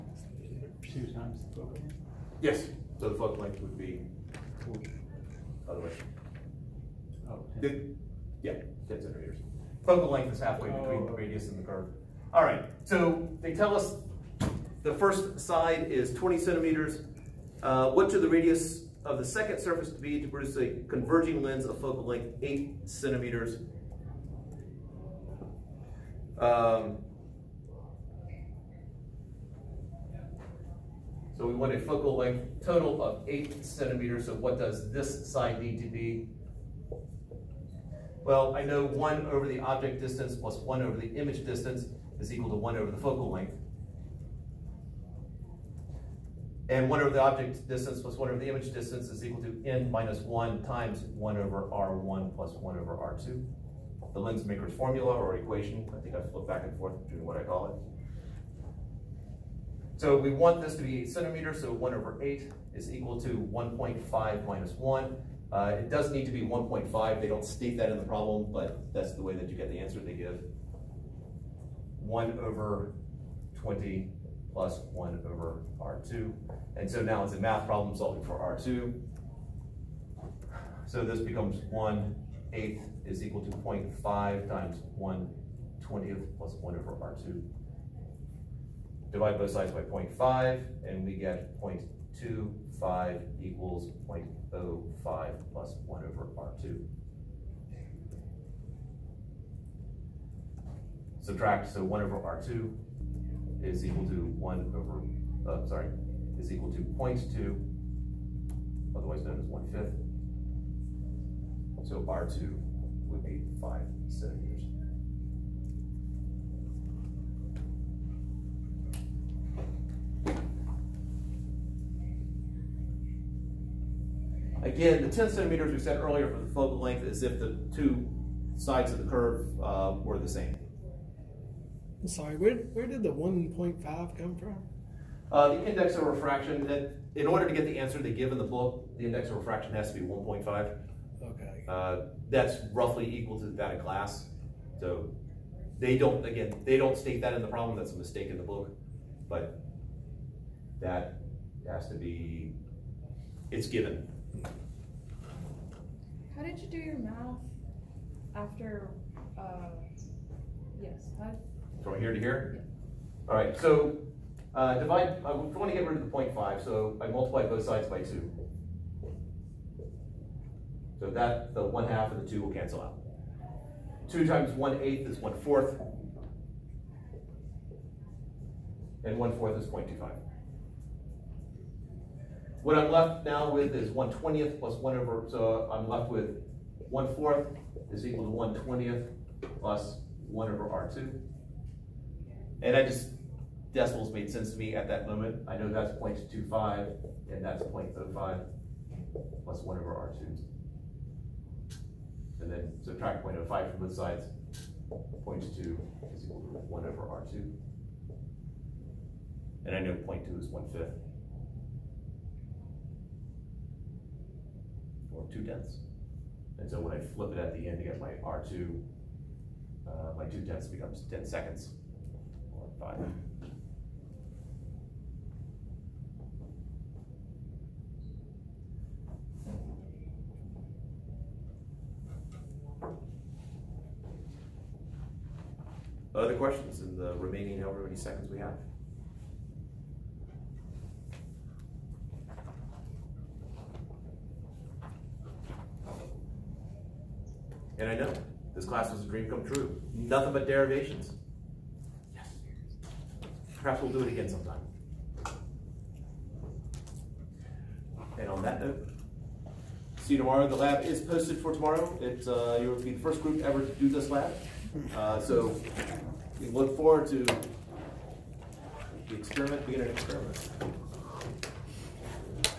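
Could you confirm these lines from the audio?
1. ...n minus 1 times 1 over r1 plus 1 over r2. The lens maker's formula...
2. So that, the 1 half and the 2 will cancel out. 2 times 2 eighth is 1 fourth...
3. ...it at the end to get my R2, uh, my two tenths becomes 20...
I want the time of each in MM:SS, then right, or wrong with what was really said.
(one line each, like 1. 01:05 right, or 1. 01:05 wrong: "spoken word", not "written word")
1. 00:49 right
2. 02:50 wrong: "1", not "2"
3. 03:37 wrong: "10", not "20".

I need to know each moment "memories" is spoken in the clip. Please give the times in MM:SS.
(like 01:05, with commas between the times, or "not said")
not said.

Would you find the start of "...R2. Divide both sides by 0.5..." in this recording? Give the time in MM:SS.
01:26.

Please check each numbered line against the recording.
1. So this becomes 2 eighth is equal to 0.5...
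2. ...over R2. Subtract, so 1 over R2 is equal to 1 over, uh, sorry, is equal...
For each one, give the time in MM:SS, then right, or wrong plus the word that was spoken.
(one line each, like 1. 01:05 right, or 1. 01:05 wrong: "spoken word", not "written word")
1. 01:20 wrong: "1", not "2"
2. 01:36 right.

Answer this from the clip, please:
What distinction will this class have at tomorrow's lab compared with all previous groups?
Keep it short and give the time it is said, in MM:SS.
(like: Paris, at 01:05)
first group ever, at 04:22.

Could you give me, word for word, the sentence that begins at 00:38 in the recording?
Well, I know 1 over the object distance plus 1 over the image distance is equal to 1 over the focal length.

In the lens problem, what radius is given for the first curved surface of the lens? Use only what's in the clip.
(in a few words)
20 centimeters.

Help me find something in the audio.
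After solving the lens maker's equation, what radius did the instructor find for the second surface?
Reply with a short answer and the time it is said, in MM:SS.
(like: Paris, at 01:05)
5 centimeters, at 01:53.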